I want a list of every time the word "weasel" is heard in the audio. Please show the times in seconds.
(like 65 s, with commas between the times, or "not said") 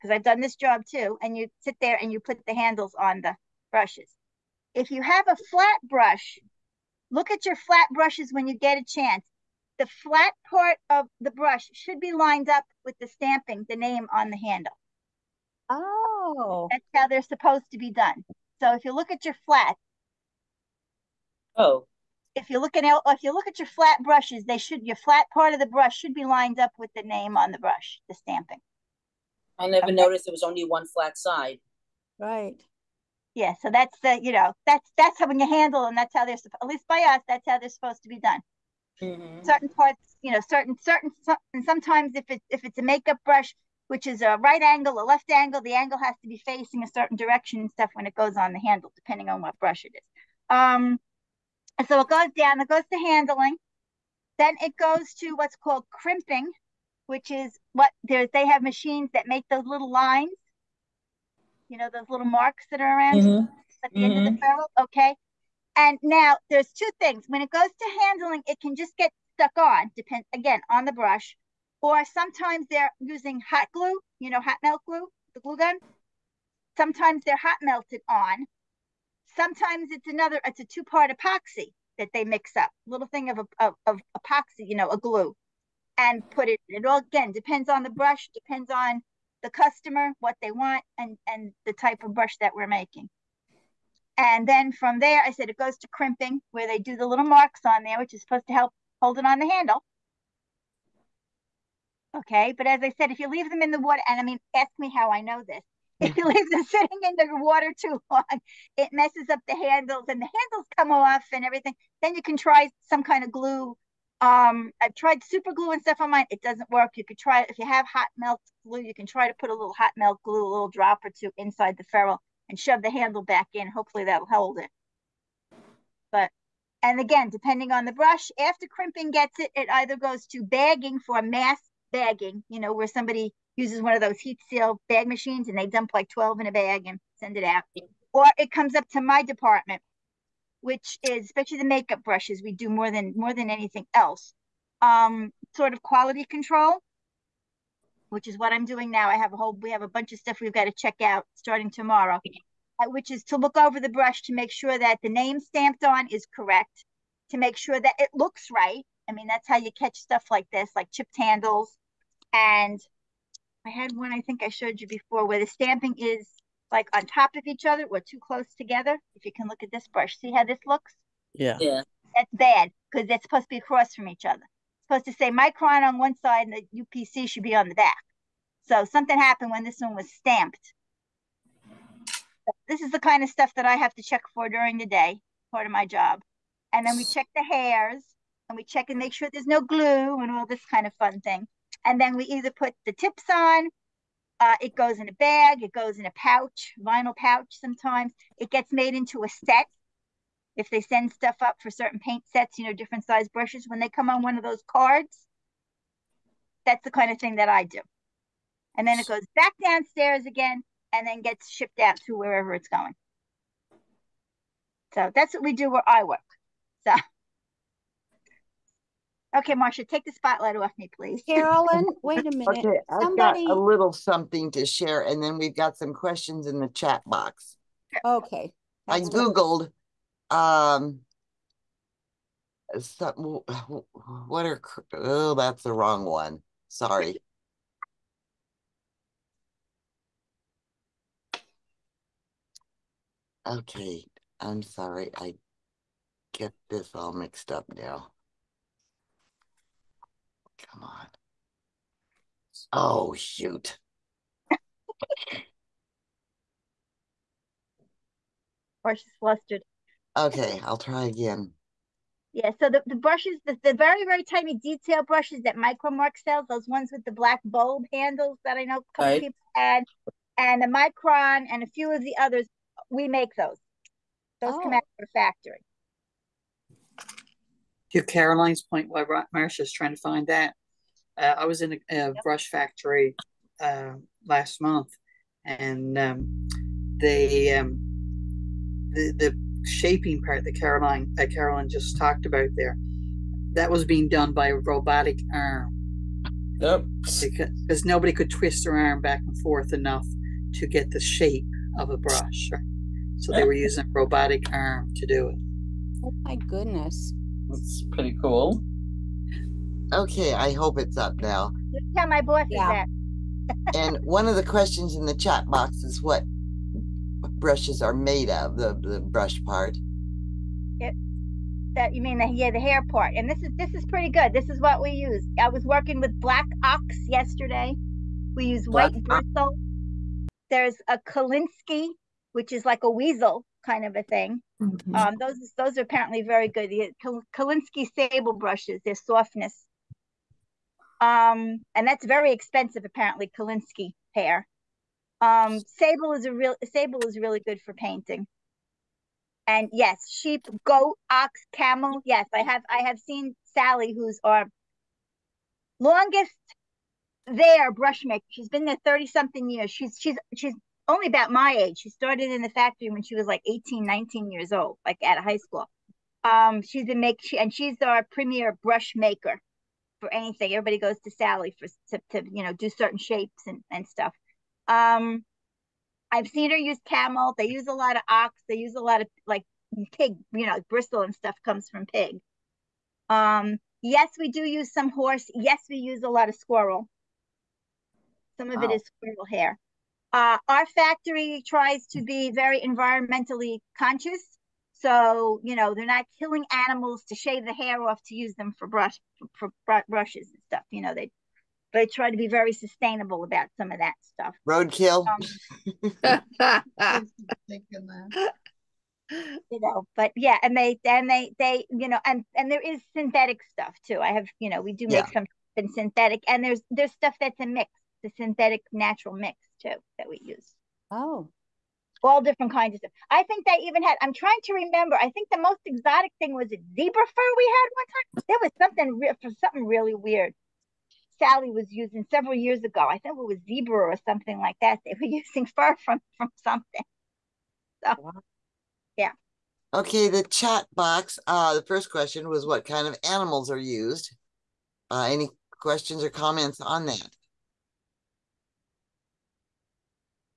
332 s.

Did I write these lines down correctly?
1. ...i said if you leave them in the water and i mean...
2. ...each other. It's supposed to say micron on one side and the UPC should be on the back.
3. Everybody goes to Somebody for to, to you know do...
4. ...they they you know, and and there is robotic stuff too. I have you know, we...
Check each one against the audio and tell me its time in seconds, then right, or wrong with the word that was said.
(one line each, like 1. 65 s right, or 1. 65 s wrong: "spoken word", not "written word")
1. 102 s right
2. 174 s right
3. 370 s wrong: "Sally", not "Somebody"
4. 411 s wrong: "synthetic", not "robotic".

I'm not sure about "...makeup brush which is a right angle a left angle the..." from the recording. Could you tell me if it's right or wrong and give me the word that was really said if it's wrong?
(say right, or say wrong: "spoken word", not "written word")
right.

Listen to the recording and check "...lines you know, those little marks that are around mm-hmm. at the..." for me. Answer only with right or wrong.
right.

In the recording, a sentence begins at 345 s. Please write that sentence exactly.
Um, sable is a real sable is really good for painting.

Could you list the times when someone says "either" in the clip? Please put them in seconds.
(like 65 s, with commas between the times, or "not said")
129 s, 192 s.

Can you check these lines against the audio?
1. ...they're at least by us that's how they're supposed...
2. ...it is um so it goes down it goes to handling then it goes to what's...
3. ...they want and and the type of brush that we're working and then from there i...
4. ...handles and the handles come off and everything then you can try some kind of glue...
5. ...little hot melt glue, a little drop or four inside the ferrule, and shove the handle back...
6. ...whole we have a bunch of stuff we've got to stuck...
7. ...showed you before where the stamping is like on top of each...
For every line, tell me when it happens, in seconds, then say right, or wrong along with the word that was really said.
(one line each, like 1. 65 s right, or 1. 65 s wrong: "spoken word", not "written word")
1. 36 s right
2. 49 s right
3. 90 s wrong: "making", not "working"
4. 109 s right
5. 119 s wrong: "two", not "four"
6. 149 s wrong: "check", not "stuck"
7. 164 s right.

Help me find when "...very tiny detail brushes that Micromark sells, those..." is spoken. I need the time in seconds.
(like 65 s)
264 s.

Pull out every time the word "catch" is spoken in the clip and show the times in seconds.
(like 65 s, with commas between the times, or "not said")
159 s.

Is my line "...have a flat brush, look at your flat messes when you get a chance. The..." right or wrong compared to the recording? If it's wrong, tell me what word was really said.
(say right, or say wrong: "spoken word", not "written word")
wrong: "brushes", not "messes".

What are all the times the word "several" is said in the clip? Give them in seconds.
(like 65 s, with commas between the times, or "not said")
432 s.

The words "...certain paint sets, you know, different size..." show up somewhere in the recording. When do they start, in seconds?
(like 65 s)
201 s.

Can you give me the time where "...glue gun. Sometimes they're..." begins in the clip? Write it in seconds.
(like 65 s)
75 s.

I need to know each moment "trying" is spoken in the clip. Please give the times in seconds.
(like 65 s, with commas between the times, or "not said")
279 s, 424 s.